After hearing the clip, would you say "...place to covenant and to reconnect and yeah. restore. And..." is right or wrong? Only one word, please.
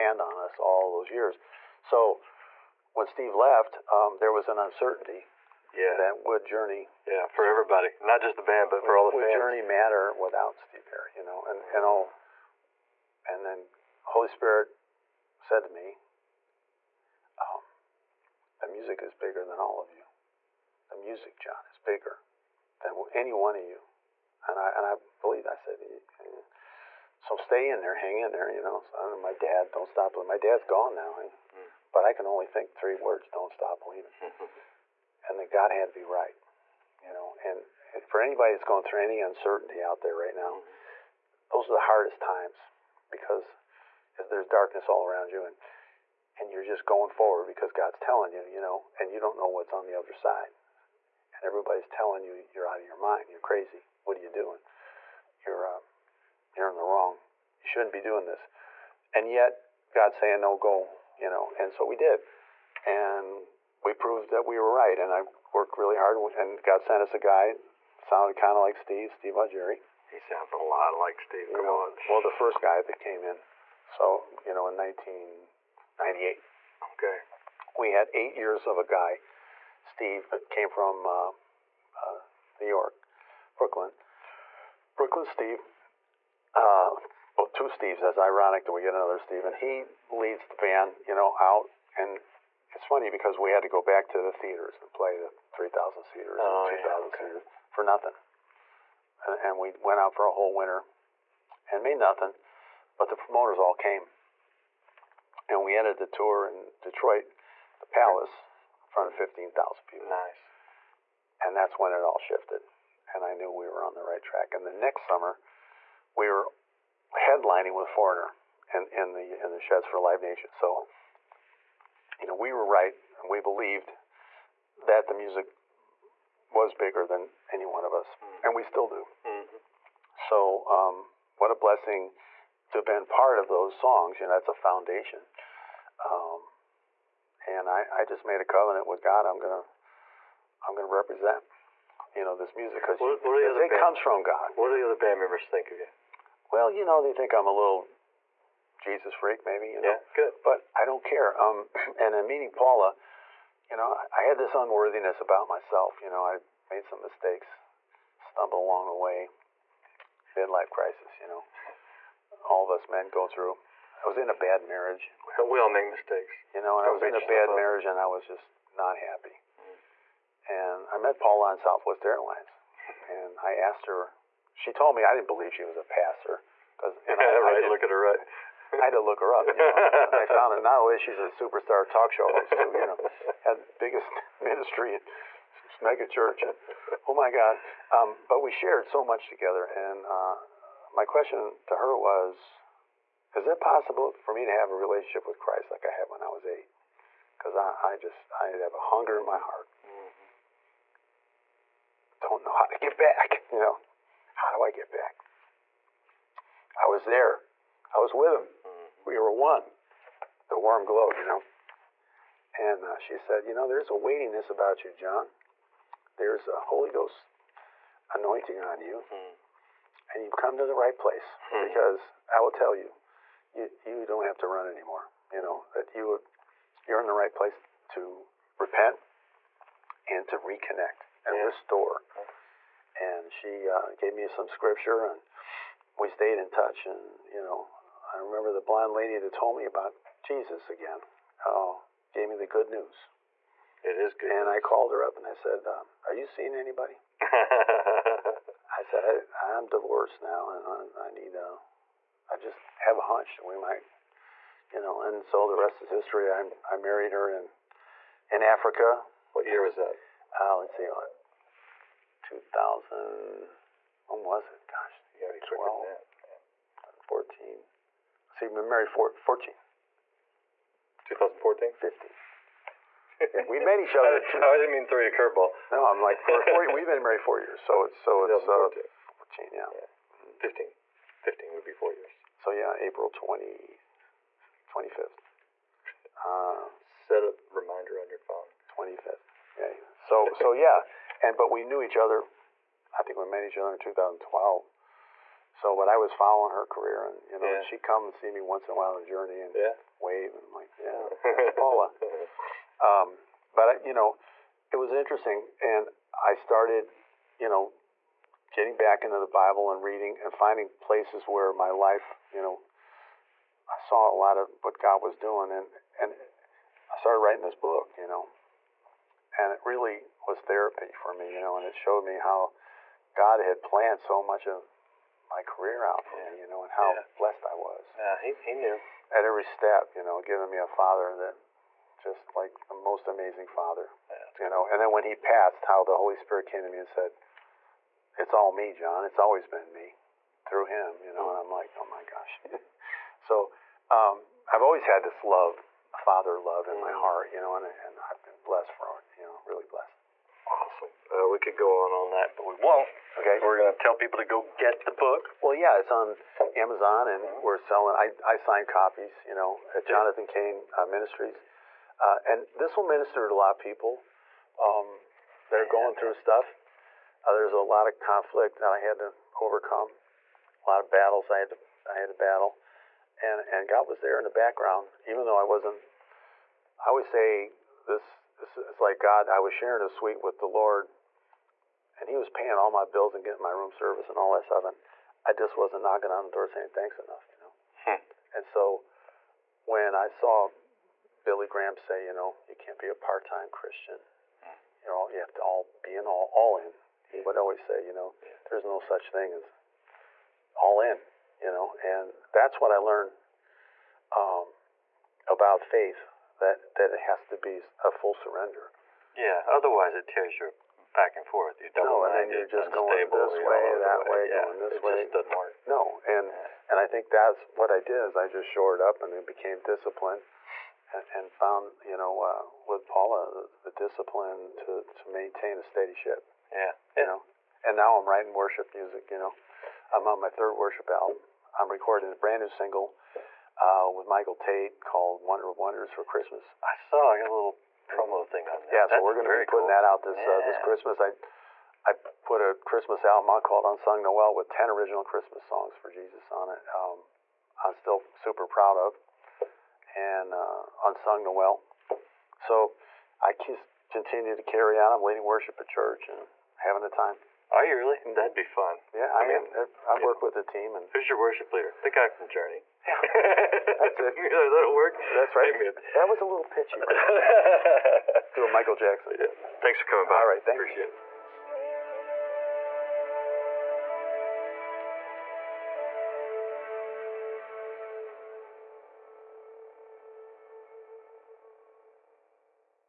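wrong.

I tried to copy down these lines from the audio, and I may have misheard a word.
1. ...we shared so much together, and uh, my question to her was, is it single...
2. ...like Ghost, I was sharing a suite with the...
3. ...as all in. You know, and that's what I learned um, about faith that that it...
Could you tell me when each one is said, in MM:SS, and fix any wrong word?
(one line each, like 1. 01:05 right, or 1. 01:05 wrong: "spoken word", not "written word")
1. 03:08 wrong: "possible", not "single"
2. 06:18 wrong: "God", not "Ghost"
3. 06:39 right.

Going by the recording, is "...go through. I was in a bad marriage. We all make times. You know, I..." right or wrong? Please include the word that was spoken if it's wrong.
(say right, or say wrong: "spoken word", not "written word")
wrong: "mistakes", not "times".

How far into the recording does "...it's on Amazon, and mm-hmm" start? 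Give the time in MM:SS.
05:55.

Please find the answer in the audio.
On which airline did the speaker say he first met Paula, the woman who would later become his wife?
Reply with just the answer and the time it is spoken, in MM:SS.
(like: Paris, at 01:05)
Southwest Airlines, at 02:51.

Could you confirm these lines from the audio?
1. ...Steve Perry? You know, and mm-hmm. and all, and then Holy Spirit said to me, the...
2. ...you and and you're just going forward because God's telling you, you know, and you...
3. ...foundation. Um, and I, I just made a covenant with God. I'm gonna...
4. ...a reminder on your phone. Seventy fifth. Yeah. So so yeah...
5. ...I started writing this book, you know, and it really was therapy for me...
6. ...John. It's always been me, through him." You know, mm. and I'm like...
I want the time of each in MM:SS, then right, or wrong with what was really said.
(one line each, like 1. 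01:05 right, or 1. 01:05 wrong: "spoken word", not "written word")
1. 00:10 right
2. 00:45 right
3. 02:14 right
4. 04:47 wrong: "Twenty", not "Seventy"
5. 05:16 right
6. 05:38 right.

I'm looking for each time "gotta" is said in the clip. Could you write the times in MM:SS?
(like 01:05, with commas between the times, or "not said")
04:25.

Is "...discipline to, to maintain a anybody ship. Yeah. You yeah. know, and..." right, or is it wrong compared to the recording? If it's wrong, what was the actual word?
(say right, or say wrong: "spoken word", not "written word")
wrong: "steady", not "anybody".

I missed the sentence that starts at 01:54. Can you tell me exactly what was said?
And the next summer, we were headlining with Foreigner in, in, the, in the sheds for Live Nation.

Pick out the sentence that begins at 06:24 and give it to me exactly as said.
And I just wasn't knocking on the door saying thanks enough, you know?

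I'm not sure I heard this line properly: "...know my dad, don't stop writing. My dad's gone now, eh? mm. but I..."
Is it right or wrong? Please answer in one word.
wrong.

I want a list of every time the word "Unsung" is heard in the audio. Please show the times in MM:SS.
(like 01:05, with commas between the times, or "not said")
07:23, 07:30.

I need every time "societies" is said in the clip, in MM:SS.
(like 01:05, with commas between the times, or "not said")
not said.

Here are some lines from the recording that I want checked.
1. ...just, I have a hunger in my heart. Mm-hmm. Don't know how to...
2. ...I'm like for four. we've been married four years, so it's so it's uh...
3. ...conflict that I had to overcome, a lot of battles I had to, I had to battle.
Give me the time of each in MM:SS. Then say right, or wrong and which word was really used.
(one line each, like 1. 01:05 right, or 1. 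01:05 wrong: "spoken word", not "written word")
1. 03:17 right
2. 04:35 right
3. 06:07 right.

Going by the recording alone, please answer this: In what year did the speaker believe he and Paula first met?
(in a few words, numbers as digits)
2012.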